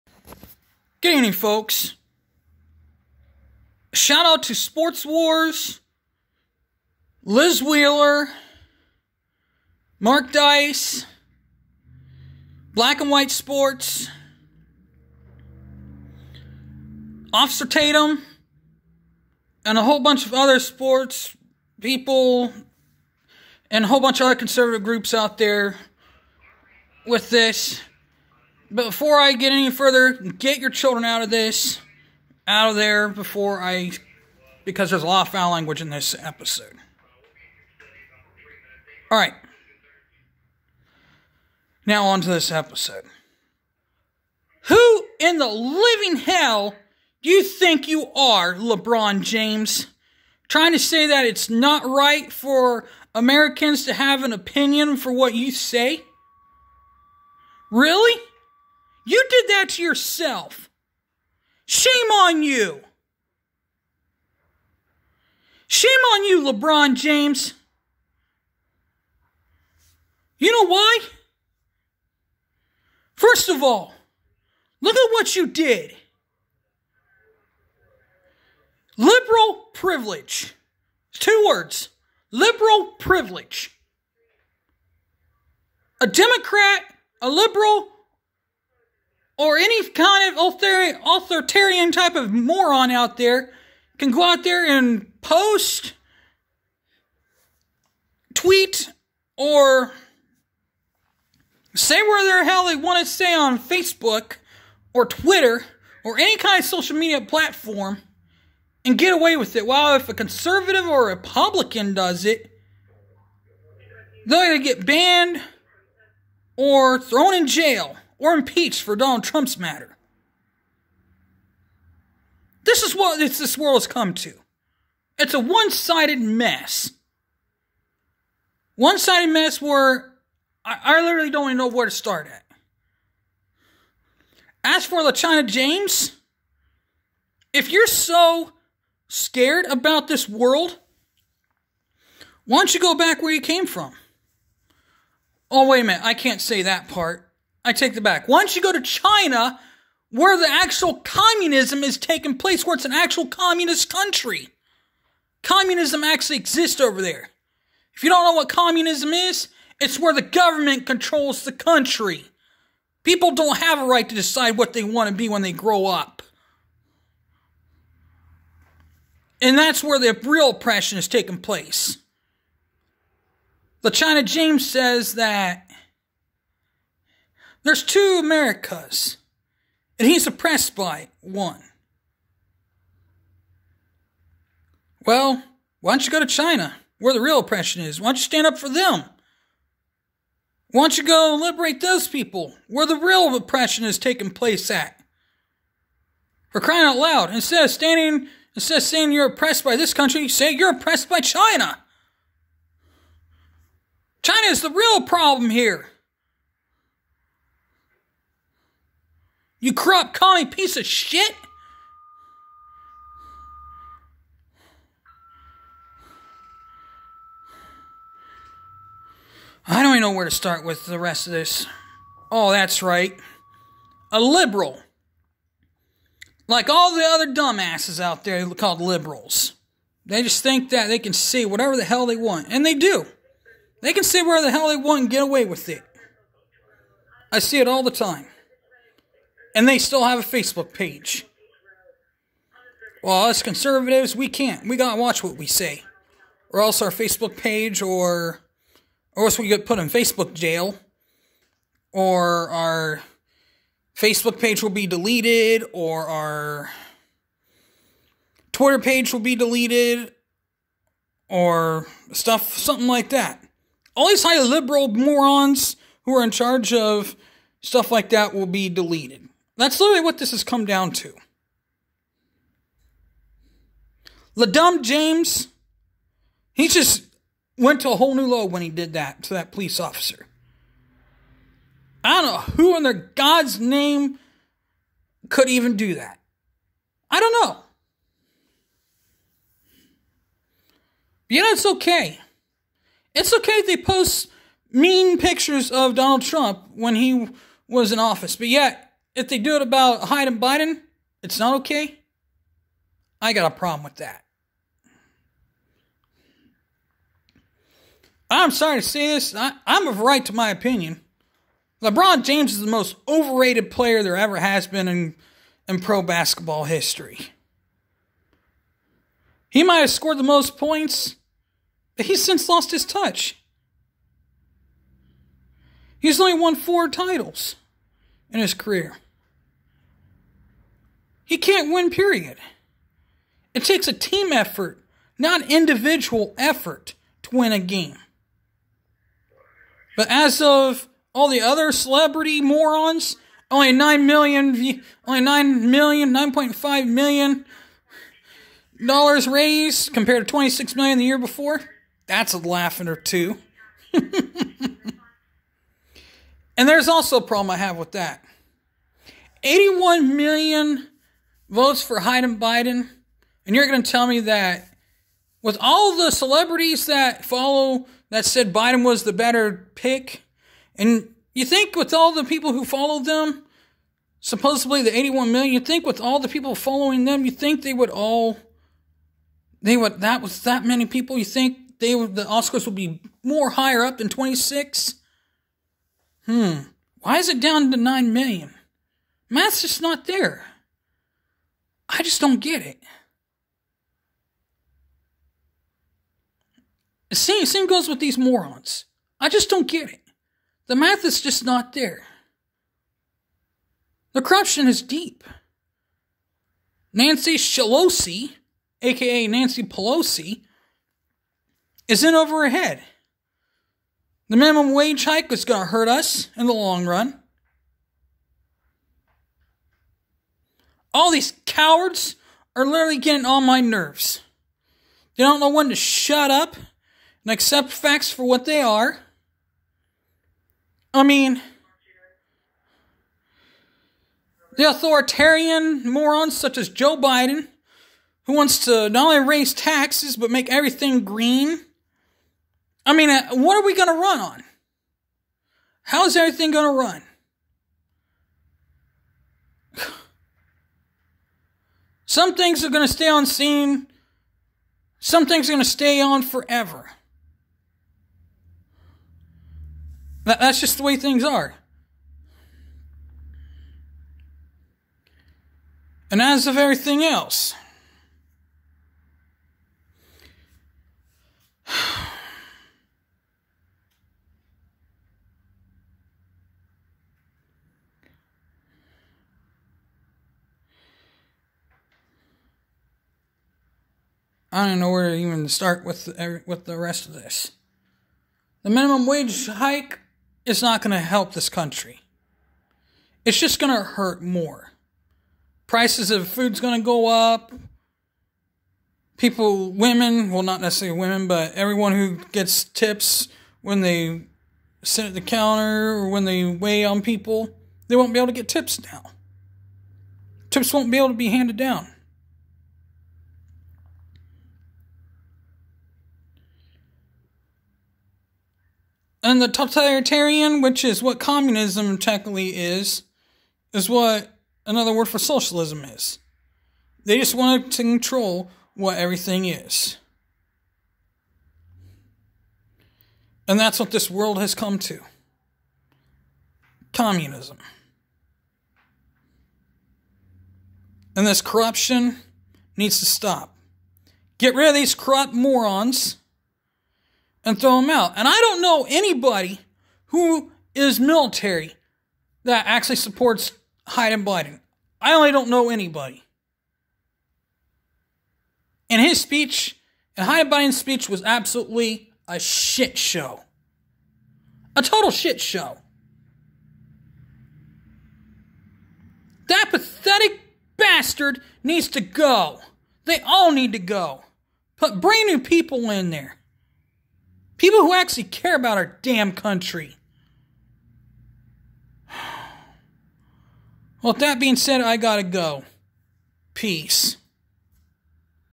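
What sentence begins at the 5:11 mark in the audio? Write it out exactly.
LeBron James is the most overrated player there ever has been in, in pro basketball history.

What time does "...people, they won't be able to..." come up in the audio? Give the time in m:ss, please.
8:27.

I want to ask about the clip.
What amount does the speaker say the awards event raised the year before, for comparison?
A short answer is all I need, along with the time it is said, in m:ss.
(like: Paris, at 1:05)
$26 million, at 5:50.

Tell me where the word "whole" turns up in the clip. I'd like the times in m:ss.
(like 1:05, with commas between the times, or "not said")
0:19, 0:23, 4:37.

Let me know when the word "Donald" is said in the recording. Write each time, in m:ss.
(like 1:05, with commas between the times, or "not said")
1:58, 4:55.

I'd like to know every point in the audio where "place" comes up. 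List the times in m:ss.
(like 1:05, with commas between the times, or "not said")
2:32, 2:51, 3:14.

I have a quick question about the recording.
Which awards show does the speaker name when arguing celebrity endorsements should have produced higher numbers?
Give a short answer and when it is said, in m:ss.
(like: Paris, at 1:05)
The Oscars, at 6:22.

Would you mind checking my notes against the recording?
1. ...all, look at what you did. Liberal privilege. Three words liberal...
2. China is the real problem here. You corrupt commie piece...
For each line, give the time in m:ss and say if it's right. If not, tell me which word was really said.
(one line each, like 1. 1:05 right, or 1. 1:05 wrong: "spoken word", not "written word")
1. 1:13 wrong: "Two", not "Three"
2. 3:24 right.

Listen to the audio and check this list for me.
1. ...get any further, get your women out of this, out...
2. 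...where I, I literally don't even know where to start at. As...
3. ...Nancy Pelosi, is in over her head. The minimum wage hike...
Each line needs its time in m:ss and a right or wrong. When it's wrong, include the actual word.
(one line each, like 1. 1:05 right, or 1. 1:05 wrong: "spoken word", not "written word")
1. 0:29 wrong: "children", not "women"
2. 2:09 right
3. 6:49 right.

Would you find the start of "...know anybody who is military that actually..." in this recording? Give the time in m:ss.
9:08.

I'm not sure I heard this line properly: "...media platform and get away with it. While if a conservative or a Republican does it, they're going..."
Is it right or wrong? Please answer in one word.
right.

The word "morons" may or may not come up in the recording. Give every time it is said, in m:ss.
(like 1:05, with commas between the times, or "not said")
1:32, 4:24, 5:42, 6:38, 7:15, 9:05.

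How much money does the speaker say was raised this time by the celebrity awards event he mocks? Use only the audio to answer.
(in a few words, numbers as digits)
$9.5 million.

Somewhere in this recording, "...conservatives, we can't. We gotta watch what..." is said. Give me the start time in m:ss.
4:03.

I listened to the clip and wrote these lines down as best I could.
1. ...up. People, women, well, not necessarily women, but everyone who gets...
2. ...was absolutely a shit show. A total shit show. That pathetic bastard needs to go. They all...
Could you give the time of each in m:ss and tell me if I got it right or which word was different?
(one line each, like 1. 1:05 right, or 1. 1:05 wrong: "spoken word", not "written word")
1. 8:17 right
2. 9:21 right.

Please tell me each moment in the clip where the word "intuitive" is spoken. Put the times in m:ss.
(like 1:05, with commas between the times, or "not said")
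not said.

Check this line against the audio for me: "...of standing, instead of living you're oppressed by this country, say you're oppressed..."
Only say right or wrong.
wrong.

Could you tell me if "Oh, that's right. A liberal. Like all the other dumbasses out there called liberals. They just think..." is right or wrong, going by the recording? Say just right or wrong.
right.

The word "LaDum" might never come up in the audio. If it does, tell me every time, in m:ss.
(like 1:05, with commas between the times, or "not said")
4:34.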